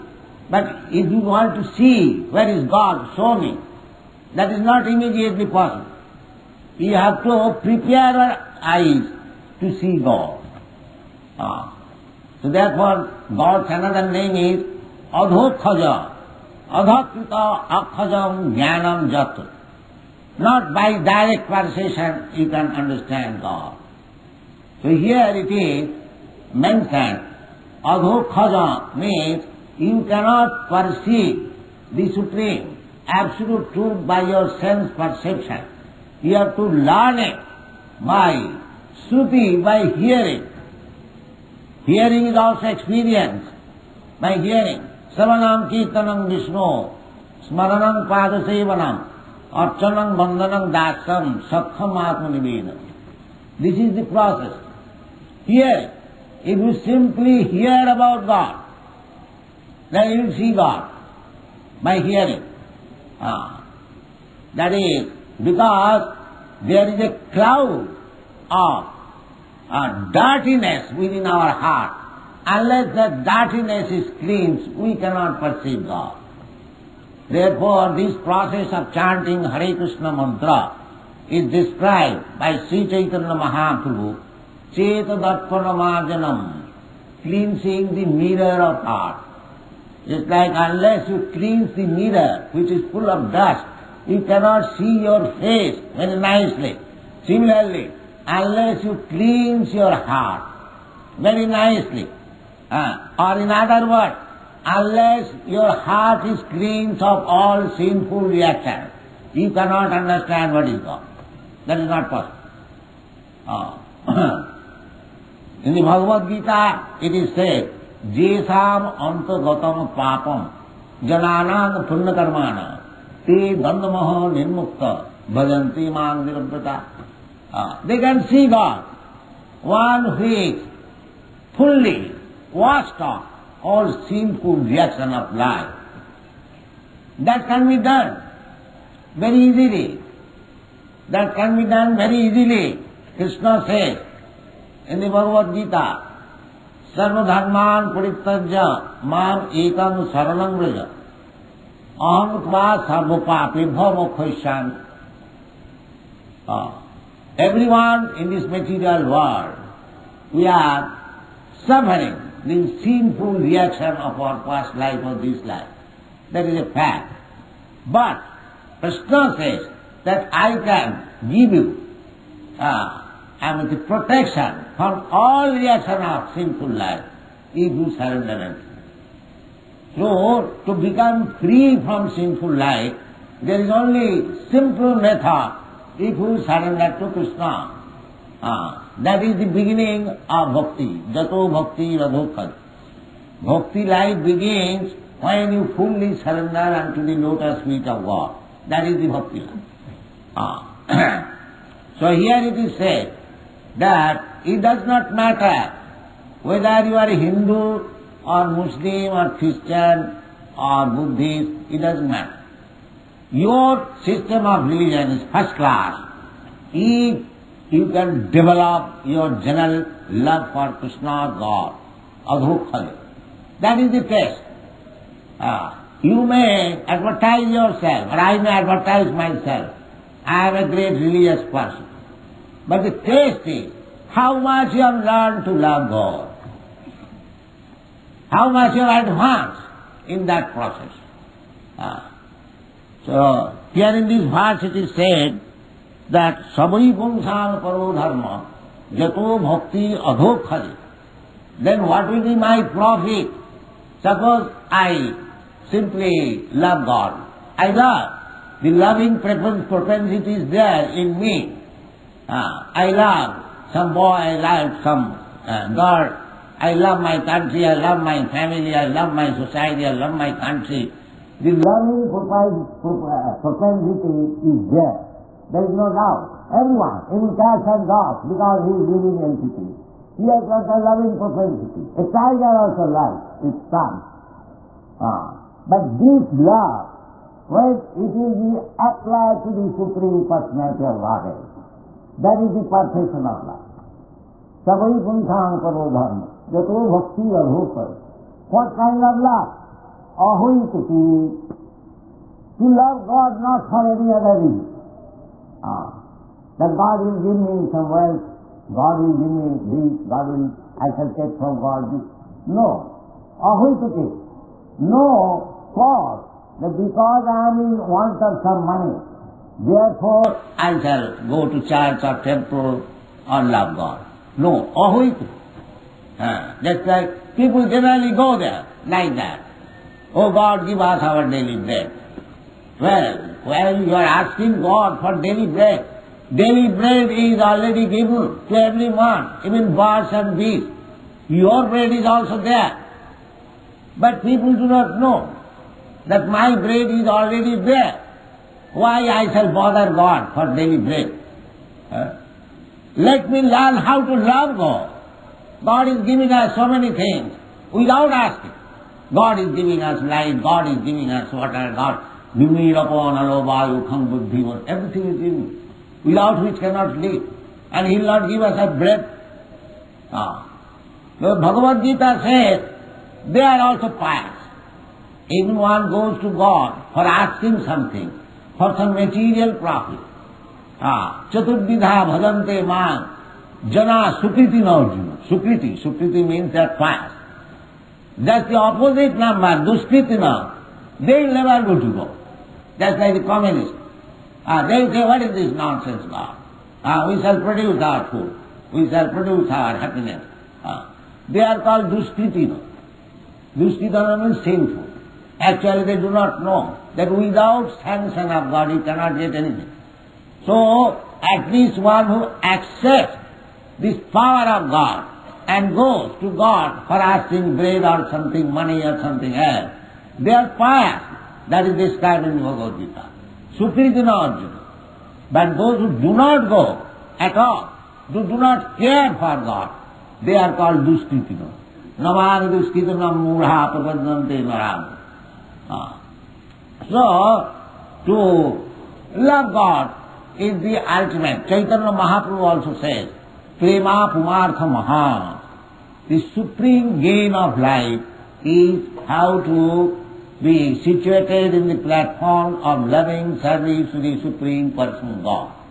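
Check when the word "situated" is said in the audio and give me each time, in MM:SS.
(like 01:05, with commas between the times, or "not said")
07:30.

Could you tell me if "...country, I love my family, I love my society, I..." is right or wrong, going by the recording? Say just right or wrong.
right.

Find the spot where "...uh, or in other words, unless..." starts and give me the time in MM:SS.
01:42.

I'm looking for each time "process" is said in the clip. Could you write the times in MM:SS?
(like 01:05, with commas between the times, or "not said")
00:54, 01:18, 04:00.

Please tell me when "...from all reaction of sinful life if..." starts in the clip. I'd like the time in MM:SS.
02:54.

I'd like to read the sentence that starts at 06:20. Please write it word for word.
Ah, Chaturdidha bhajante man, jana sukriti narjuna.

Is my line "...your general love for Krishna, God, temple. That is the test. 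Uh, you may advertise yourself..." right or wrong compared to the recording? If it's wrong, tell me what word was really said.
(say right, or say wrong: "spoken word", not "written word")
wrong: "adhukhale", not "temple".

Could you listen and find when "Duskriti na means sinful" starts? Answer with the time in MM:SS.
06:43.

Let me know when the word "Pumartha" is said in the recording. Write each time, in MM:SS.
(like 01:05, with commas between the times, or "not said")
07:24.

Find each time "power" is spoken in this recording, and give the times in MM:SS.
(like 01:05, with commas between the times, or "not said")
06:54.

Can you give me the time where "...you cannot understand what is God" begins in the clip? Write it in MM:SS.
01:49.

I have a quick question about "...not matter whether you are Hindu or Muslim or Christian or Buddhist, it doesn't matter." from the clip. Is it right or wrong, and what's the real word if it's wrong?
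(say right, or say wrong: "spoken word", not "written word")
right.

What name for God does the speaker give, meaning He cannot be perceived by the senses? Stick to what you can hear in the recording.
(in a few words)
Adhokhaja.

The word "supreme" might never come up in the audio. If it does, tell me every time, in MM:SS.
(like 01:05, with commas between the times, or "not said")
00:32, 04:49, 07:26, 07:34.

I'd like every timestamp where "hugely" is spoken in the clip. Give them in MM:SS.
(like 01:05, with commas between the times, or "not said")
not said.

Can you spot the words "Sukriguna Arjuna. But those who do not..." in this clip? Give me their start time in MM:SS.
07:03.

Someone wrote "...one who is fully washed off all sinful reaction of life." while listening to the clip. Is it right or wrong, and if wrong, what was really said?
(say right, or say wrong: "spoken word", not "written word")
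right.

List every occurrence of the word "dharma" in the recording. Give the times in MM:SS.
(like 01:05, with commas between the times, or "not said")
04:07, 04:55.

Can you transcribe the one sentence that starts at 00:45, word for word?
Savanam kirtanam Vishnu, smaranam padasevanam, archanam bandhanam dasam, sakham atmanivedam.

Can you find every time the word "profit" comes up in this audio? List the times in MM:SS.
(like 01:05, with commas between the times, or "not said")
04:12, 06:19.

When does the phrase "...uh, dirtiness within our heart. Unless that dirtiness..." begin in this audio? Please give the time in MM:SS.
01:09.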